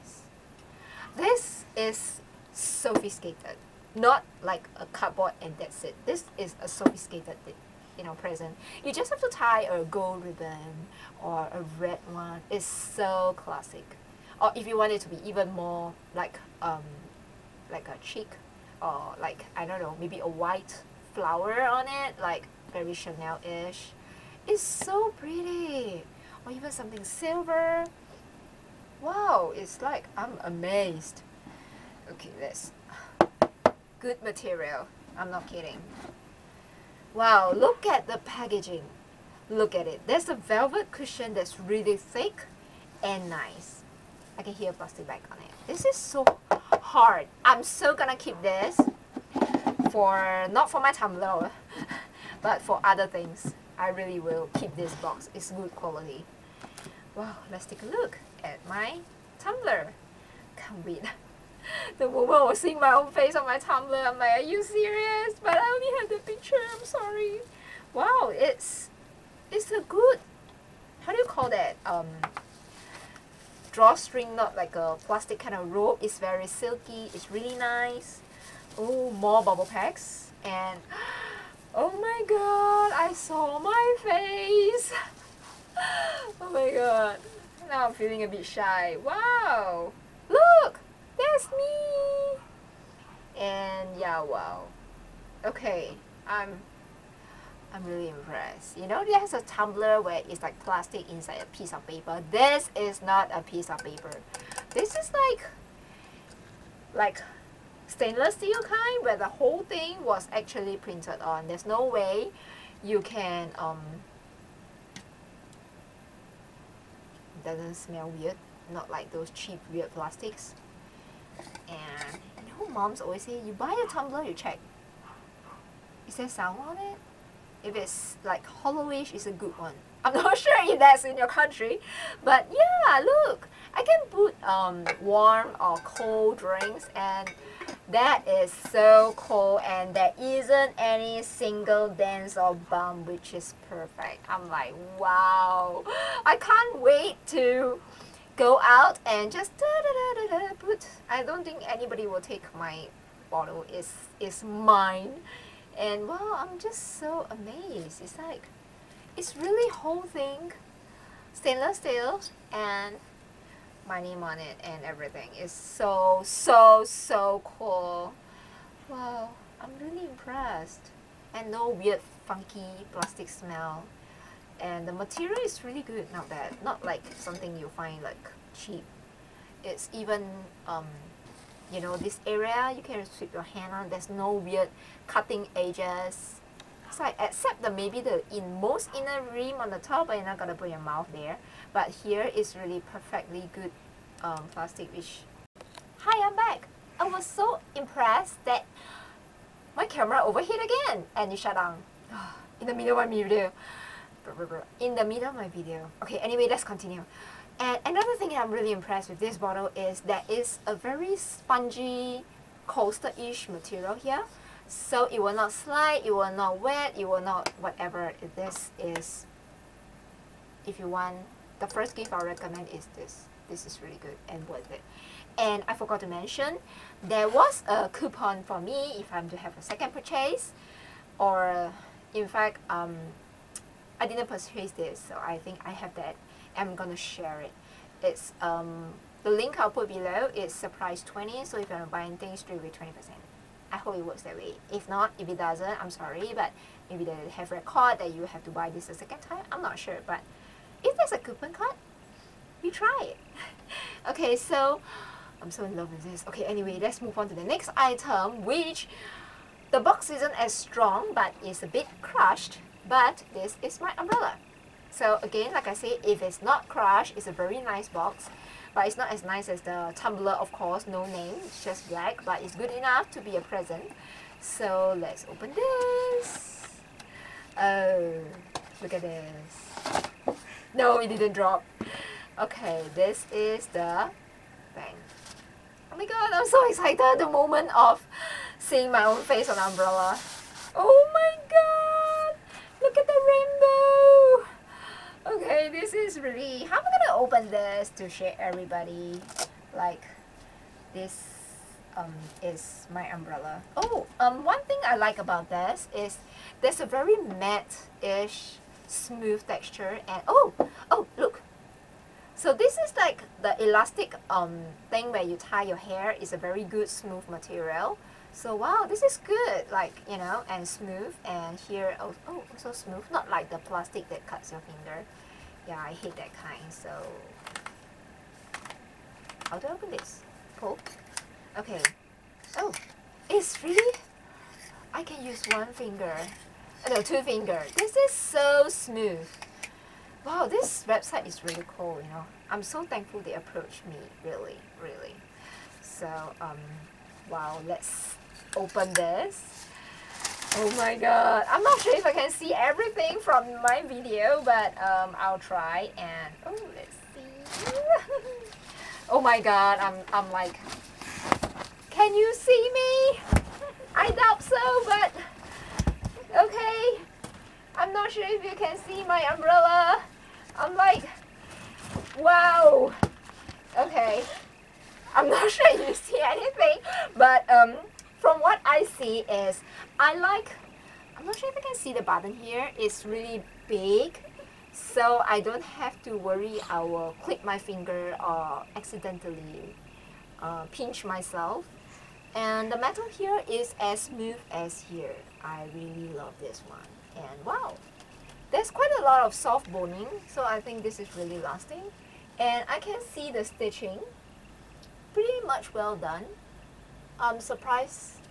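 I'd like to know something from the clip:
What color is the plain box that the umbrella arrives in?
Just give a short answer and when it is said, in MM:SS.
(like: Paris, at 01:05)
black, at 04:31.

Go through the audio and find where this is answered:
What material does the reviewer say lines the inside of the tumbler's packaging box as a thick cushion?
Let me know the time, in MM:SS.
00:40.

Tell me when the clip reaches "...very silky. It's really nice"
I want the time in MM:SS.
01:16.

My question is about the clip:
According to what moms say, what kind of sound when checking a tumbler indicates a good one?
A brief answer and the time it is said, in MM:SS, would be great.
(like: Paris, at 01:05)
hollowish, at 02:08.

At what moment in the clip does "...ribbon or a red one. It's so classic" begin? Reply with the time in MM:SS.
00:10.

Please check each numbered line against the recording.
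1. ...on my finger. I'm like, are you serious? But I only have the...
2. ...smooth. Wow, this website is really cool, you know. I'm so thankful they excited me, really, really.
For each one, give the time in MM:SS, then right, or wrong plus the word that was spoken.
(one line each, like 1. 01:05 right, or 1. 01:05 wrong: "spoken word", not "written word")
1. 01:03 wrong: "tumbler", not "finger"
2. 05:38 wrong: "approached", not "excited".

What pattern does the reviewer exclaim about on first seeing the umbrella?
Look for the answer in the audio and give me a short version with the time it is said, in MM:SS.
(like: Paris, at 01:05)
rainbow, at 04:53.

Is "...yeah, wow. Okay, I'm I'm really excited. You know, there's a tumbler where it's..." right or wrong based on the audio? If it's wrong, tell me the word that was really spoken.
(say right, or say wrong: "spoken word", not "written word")
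wrong: "impressed", not "excited".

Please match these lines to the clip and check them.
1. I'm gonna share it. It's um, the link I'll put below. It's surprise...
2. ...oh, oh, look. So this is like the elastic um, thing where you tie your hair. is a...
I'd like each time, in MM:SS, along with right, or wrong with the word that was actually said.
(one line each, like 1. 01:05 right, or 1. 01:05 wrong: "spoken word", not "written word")
1. 03:56 right
2. 05:10 right.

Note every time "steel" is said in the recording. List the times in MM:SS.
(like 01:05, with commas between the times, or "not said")
01:48, 02:41.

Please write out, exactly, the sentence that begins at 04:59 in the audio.
Like, this um, is my umbrella.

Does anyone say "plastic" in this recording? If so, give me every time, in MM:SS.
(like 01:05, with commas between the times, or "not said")
00:44, 01:15, 01:40, 01:59, 02:52, 03:14, 05:23.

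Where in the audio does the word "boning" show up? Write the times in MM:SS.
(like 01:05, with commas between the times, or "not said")
06:39.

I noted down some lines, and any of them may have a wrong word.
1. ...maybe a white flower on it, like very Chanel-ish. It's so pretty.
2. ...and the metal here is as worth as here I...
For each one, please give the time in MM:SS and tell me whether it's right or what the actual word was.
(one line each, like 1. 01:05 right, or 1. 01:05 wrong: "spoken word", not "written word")
1. 00:19 right
2. 06:32 wrong: "smooth", not "worth".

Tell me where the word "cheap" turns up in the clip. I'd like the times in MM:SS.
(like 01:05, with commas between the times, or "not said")
01:59, 02:58.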